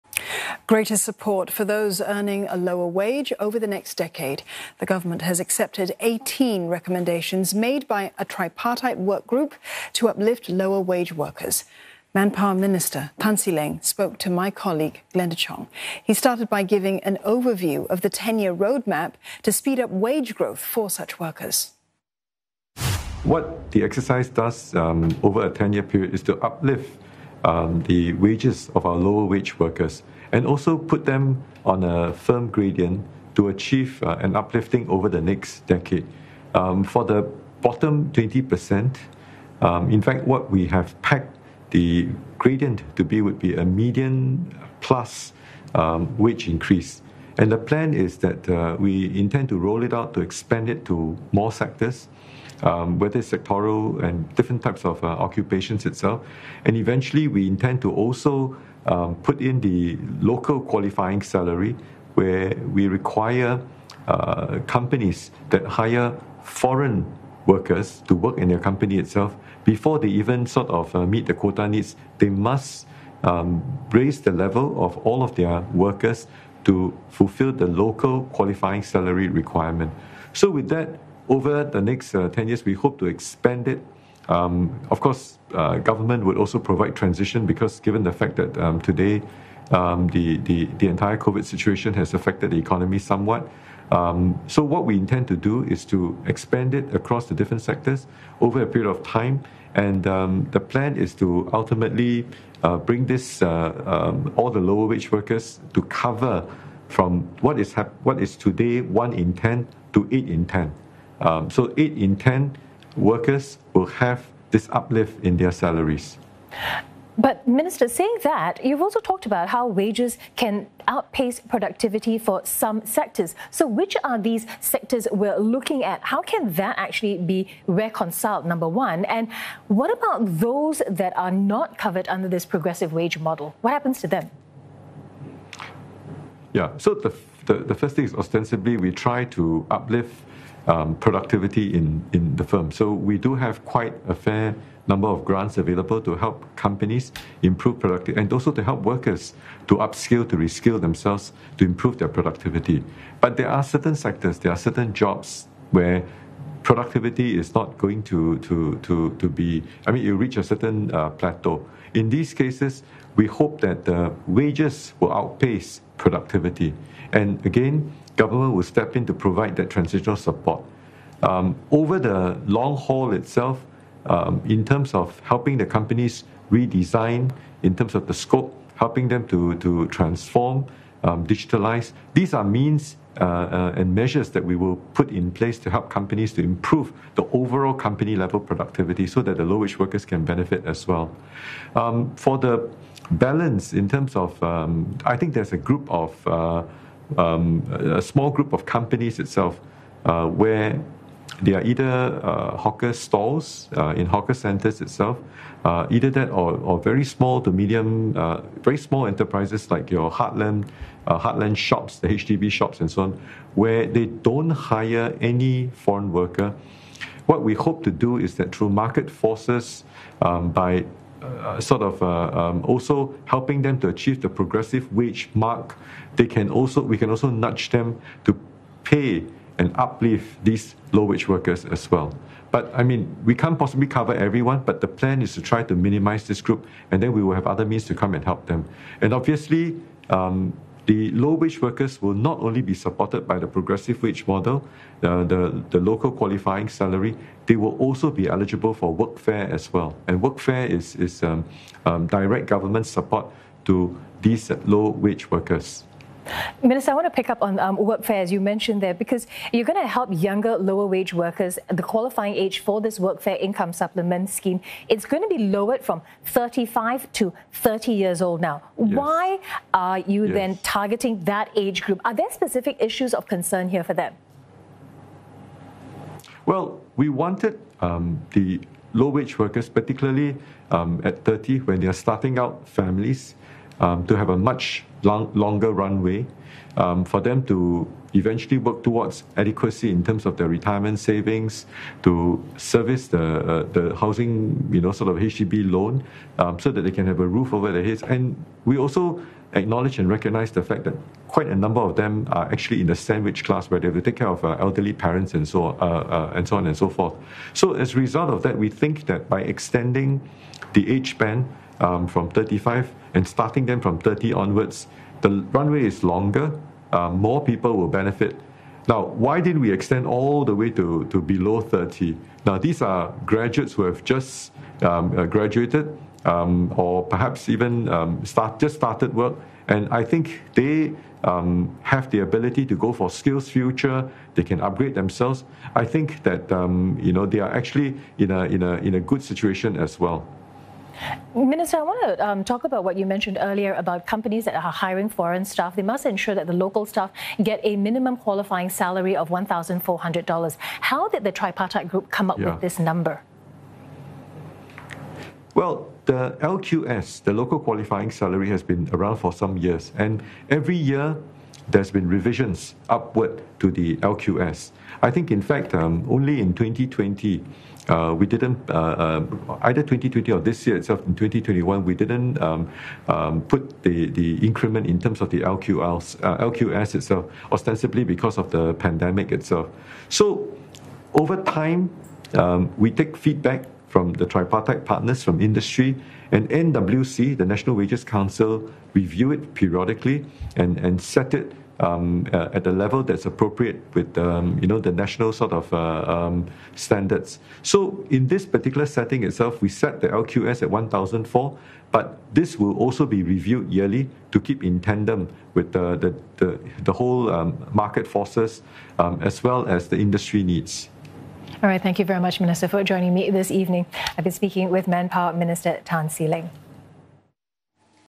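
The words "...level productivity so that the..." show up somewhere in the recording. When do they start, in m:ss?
3:08.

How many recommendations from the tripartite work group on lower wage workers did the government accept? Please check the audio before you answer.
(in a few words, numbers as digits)
18.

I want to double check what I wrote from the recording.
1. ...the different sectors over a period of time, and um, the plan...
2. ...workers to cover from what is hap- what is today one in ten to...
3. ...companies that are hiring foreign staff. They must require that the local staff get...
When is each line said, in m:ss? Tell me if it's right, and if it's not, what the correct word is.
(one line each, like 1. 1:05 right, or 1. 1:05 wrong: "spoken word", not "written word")
1. 1:37 right
2. 1:45 right
3. 5:44 wrong: "ensure", not "require".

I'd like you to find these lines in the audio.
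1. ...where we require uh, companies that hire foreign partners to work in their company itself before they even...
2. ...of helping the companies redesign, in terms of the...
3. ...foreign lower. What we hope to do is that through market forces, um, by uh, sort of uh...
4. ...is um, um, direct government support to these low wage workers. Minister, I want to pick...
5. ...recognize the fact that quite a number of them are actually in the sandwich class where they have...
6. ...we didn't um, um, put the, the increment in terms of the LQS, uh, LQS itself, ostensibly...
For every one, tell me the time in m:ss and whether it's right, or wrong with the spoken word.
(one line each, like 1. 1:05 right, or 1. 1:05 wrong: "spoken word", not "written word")
1. 1:02 wrong: "workers", not "partners"
2. 2:55 right
3. 3:35 wrong: "worker", not "lower"
4. 4:10 right
5. 5:00 right
6. 6:11 right.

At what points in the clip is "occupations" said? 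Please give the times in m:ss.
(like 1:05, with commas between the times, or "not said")
0:55.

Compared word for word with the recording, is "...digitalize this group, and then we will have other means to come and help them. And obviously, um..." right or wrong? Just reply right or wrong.
wrong.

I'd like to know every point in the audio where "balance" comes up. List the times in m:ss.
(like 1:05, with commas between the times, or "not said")
3:13.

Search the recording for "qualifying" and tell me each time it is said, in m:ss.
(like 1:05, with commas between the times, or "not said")
1:00, 1:18, 4:06, 4:21, 5:48, 5:57.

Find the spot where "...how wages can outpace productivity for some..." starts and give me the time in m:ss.
1:59.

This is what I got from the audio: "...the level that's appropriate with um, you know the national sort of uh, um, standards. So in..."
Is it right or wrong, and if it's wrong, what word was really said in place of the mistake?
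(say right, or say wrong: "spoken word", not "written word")
right.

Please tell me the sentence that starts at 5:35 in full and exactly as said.
I think that um, you know they are actually in a, in a, in a good situation as well.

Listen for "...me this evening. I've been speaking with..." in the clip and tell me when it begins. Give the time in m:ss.
6:53.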